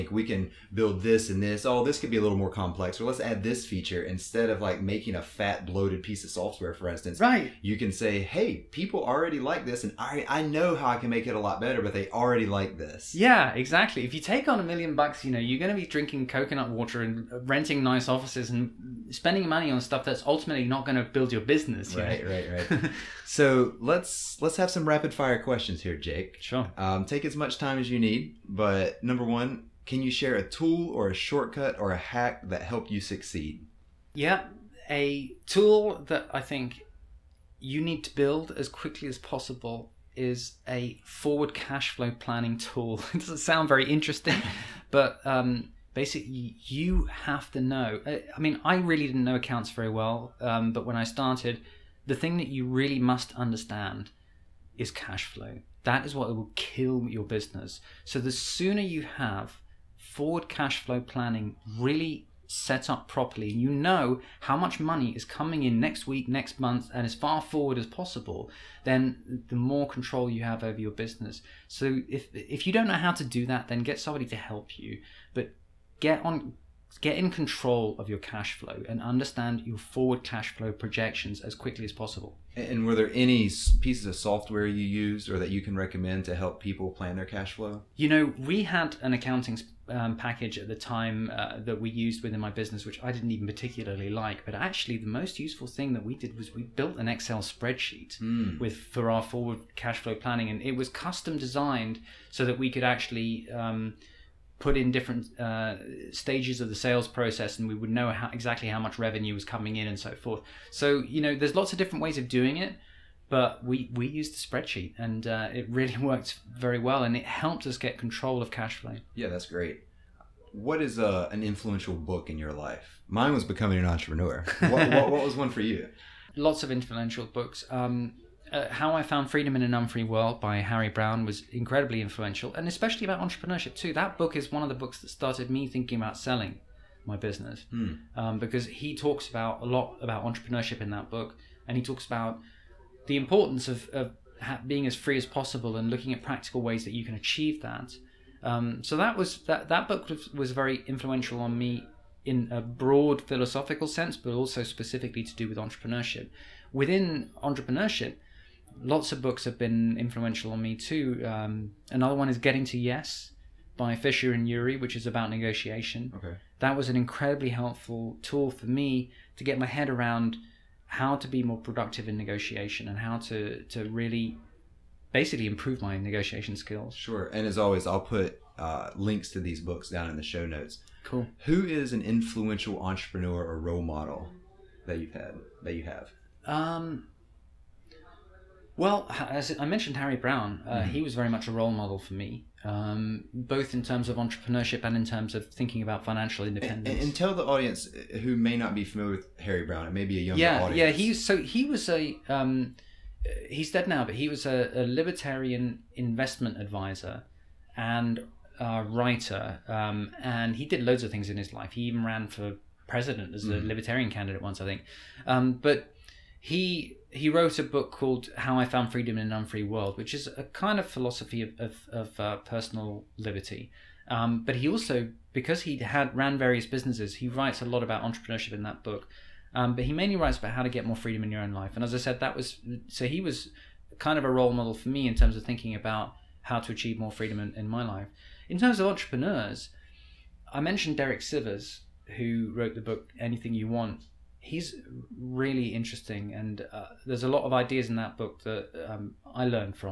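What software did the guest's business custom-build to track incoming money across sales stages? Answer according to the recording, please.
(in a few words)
Excel spreadsheet.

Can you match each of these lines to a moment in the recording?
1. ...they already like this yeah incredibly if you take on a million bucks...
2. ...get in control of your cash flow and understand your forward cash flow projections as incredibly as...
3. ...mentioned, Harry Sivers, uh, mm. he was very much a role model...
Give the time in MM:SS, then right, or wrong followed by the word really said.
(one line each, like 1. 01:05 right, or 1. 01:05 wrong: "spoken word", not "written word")
1. 00:11 wrong: "exactly", not "incredibly"
2. 01:16 wrong: "quickly", not "incredibly"
3. 03:09 wrong: "Browne", not "Sivers".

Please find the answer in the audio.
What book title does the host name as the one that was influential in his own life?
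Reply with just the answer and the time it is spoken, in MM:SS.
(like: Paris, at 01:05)
Becoming an Entrepreneur, at 02:03.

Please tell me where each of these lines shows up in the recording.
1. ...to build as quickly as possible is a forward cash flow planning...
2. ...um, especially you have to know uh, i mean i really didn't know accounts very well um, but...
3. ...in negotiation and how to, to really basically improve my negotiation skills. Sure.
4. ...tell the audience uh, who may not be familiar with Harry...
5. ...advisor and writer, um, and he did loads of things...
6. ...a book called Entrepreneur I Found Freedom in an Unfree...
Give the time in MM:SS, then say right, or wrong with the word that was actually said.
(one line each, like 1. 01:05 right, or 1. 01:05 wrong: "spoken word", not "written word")
1. 00:38 right
2. 00:45 wrong: "basically", not "especially"
3. 02:52 right
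4. 03:17 right
5. 03:26 right
6. 03:37 wrong: "How", not "Entrepreneur".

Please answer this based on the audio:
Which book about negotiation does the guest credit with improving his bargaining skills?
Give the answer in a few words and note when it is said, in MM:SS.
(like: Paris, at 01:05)
Getting to Yes, at 02:42.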